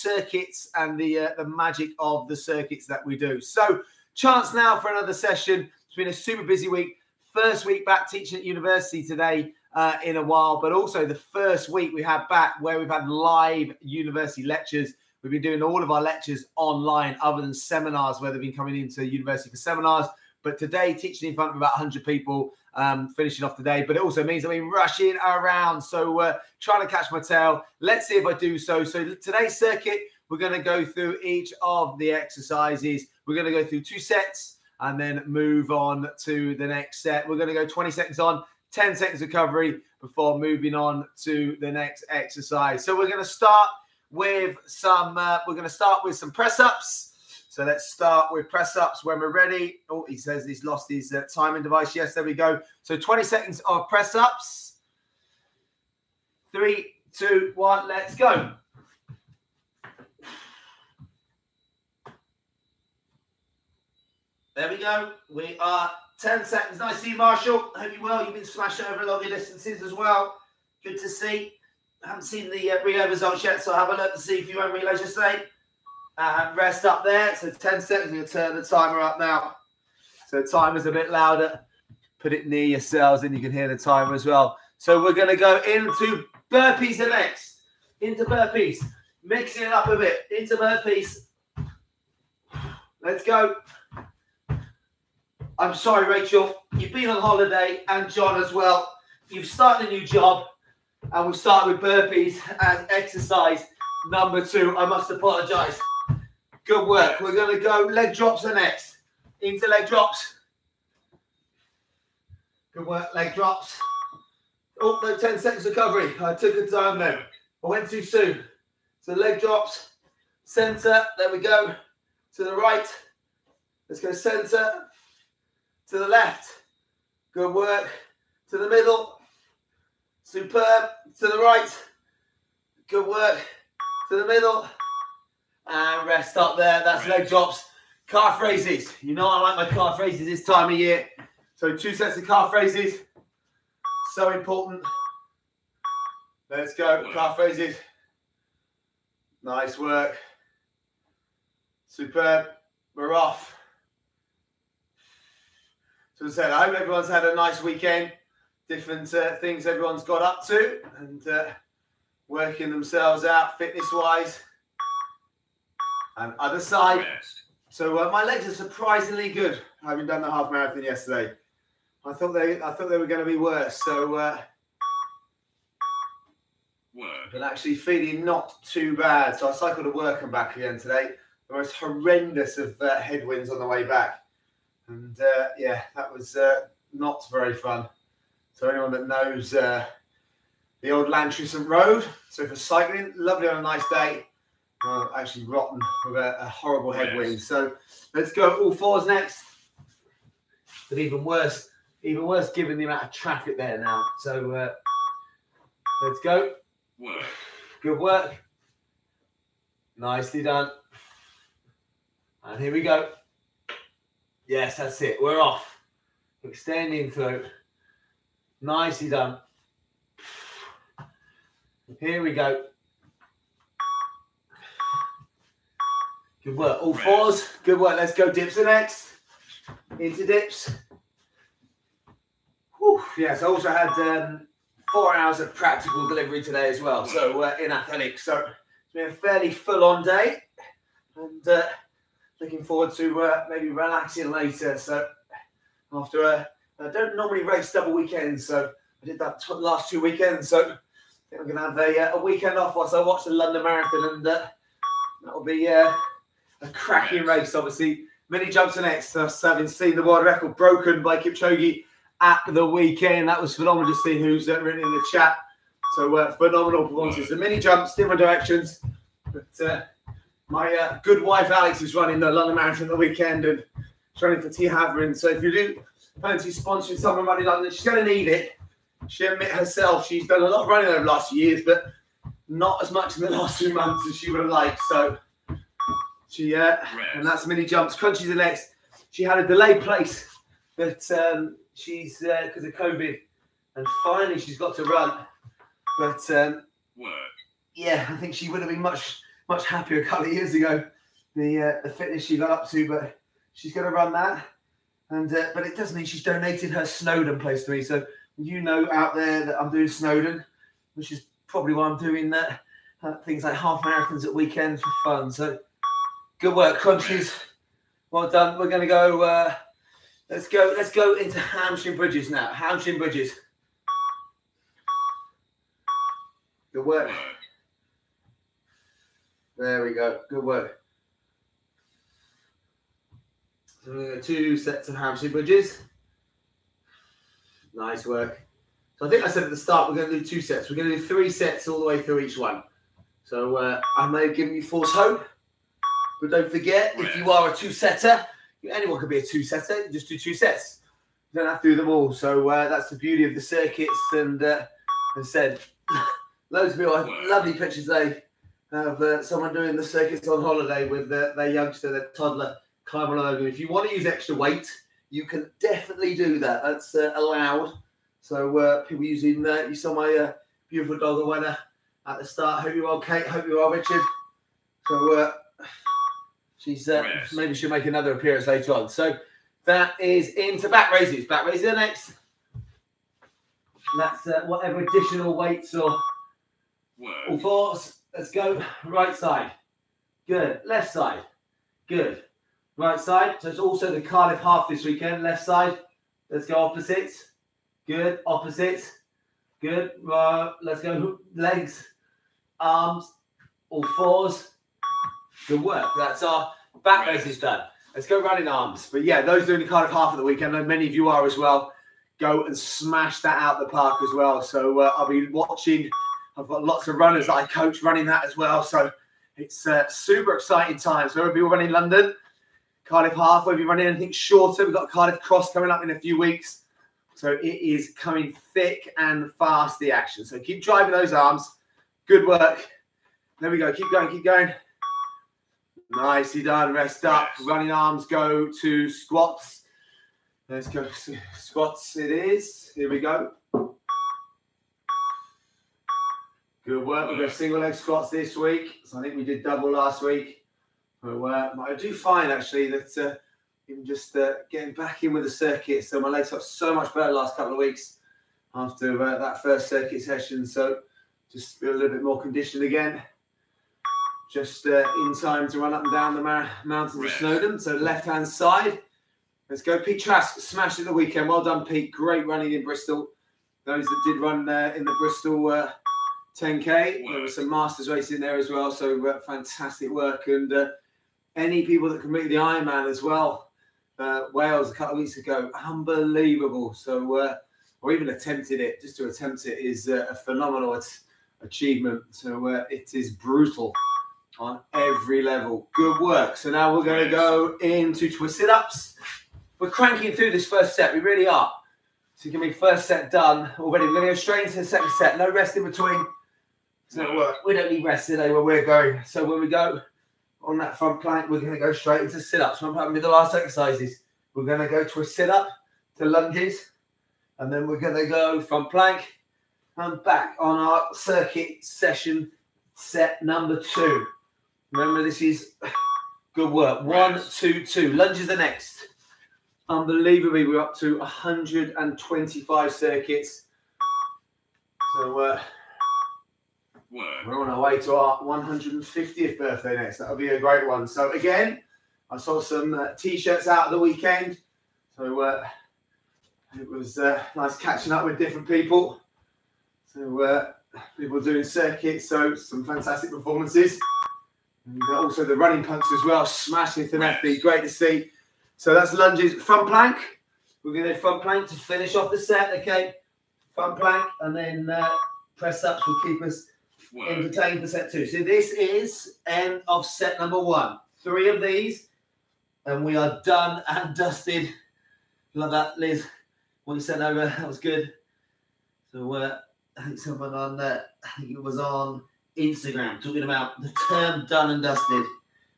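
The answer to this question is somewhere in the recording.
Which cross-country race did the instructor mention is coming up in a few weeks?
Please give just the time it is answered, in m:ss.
7:04.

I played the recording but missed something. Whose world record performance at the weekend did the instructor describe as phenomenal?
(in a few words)
Kipchoge.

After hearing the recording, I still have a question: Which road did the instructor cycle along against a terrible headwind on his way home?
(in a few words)
Llantrisant Road.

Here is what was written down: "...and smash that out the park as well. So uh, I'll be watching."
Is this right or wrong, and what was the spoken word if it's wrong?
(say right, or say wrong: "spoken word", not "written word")
right.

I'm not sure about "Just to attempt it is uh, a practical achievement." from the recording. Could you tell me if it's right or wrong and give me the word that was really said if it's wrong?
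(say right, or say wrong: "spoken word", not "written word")
wrong: "phenomenal", not "practical".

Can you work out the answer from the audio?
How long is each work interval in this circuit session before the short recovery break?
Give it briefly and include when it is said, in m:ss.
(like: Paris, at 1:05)
20 seconds, at 0:37.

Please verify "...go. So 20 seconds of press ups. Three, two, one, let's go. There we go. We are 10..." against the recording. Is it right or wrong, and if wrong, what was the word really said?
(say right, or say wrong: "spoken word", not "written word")
right.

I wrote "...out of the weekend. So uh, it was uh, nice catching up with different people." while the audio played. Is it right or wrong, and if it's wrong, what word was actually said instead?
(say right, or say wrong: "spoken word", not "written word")
right.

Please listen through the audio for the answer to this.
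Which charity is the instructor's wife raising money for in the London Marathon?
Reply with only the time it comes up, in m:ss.
4:34.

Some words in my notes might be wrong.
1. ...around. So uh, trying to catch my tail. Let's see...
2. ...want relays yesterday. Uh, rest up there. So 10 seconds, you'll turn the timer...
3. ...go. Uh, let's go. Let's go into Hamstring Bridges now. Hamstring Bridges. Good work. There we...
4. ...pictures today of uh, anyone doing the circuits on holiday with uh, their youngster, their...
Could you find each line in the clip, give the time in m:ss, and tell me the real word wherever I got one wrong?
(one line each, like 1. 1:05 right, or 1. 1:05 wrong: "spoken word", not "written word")
1. 0:25 right
2. 1:14 right
3. 5:18 right
4. 5:57 wrong: "someone", not "anyone".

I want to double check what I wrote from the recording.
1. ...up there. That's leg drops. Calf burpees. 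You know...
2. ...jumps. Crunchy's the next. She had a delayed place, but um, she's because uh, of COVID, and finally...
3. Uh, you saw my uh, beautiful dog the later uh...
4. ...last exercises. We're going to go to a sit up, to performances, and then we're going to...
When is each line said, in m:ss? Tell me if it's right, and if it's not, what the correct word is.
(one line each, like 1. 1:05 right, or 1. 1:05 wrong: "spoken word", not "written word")
1. 2:16 wrong: "raises", not "burpees"
2. 4:47 right
3. 6:09 wrong: "winner", not "later"
4. 8:33 wrong: "lunges", not "performances".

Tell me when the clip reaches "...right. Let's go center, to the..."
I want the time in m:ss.
2:02.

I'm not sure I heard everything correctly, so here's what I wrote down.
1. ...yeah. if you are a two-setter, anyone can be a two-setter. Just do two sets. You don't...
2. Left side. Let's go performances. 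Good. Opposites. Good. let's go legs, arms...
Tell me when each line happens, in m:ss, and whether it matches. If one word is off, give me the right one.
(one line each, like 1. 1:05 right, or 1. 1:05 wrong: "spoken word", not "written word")
1. 5:46 right
2. 6:35 wrong: "opposites", not "performances".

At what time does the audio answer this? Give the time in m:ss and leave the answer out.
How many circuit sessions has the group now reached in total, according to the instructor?
8:50.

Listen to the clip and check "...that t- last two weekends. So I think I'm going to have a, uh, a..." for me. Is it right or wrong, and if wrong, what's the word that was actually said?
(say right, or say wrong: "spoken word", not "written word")
right.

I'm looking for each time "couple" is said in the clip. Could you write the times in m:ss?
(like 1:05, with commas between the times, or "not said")
5:00, 7:37, 8:04.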